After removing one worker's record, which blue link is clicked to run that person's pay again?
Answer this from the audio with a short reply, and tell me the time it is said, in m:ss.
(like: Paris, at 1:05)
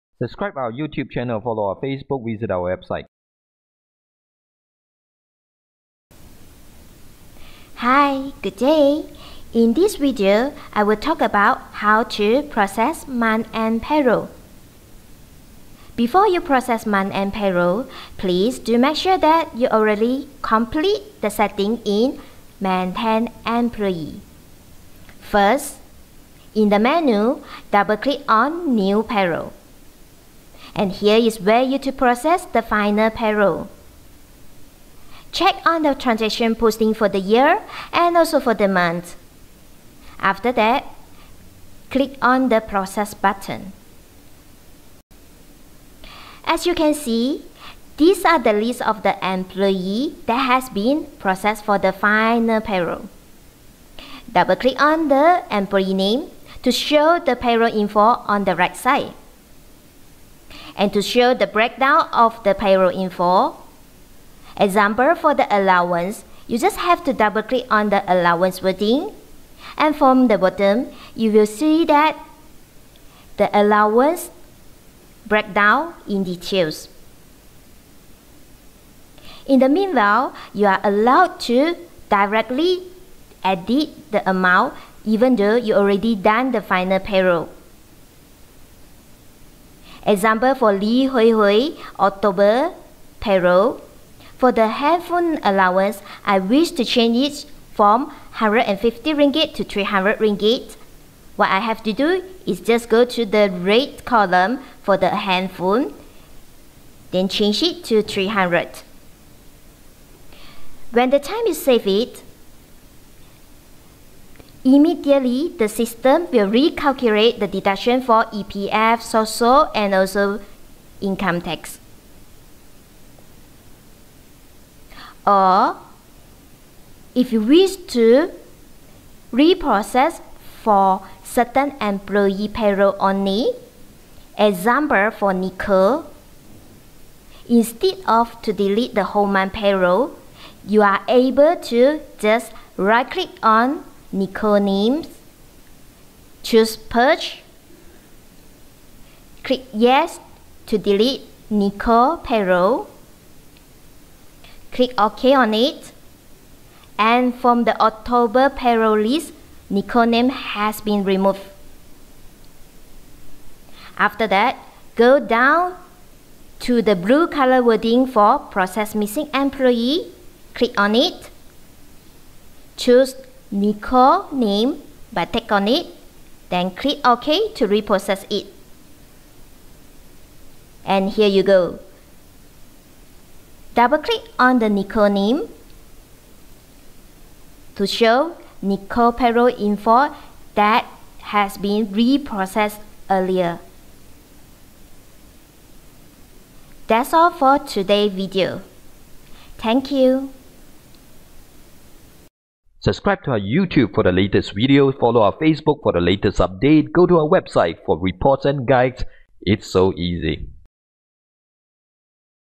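process missing employee, at 2:48.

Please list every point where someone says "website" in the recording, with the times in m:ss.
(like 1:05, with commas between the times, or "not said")
0:02, 3:27.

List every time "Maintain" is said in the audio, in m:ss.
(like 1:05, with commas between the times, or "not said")
0:22.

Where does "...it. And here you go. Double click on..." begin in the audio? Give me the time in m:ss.
2:58.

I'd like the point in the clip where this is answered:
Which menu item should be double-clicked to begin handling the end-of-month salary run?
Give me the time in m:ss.
0:28.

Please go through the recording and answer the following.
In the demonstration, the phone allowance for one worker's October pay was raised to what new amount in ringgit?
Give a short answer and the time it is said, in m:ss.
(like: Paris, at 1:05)
300, at 1:39.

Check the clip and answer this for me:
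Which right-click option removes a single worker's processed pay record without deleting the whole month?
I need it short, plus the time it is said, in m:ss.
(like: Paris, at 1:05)
Purge, at 2:26.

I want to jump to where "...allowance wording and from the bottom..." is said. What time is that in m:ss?
1:08.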